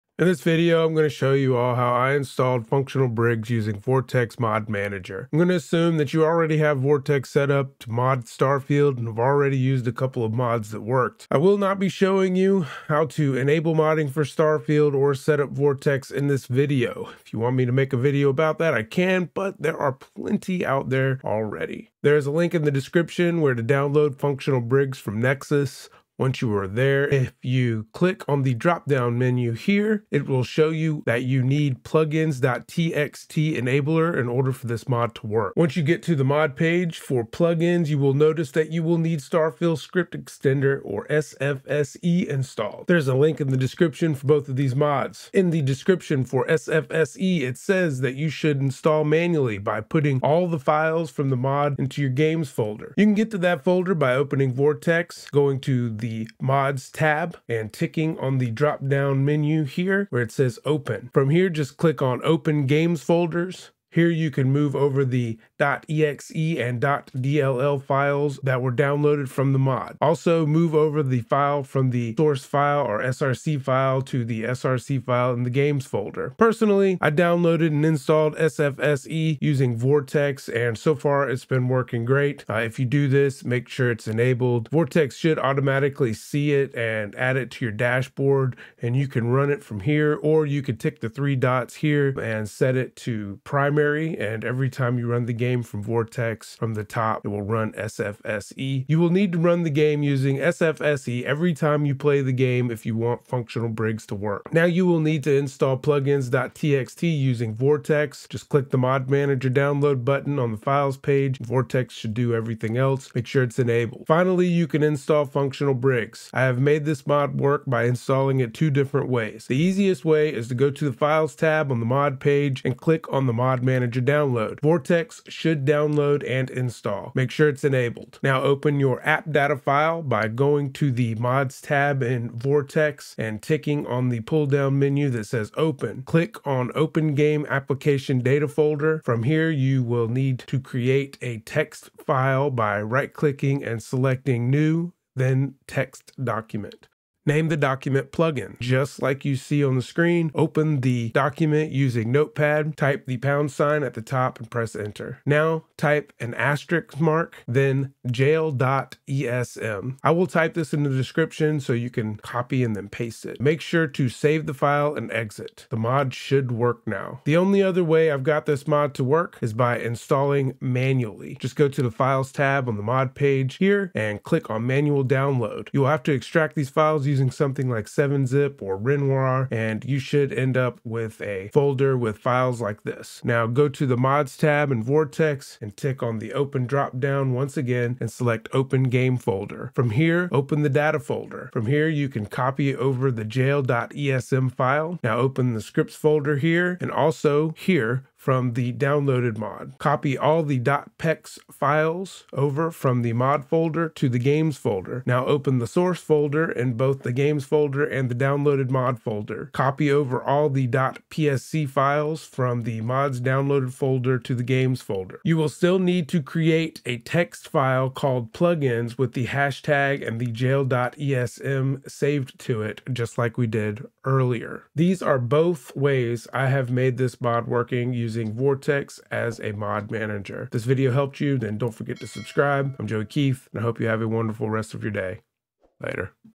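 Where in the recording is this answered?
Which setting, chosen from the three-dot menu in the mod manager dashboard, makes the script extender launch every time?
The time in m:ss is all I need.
1:32.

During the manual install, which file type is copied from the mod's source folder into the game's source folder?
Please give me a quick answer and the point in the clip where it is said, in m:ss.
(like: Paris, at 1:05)
.psc, at 3:30.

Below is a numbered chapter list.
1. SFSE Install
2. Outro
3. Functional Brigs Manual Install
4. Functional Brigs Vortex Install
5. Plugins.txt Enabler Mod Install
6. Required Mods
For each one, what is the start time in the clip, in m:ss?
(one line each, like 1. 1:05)
1. 0:43
2. 3:45
3. 2:48
4. 1:54
5. 1:44
6. 0:25.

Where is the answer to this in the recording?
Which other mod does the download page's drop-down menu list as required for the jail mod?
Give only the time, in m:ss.
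0:31.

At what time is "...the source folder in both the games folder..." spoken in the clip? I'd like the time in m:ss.
3:25.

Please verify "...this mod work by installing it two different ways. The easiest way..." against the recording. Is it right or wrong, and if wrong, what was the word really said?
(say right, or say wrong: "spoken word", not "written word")
right.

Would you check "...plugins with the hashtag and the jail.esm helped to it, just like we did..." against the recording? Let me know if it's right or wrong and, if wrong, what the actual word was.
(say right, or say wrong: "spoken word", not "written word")
wrong: "saved", not "helped".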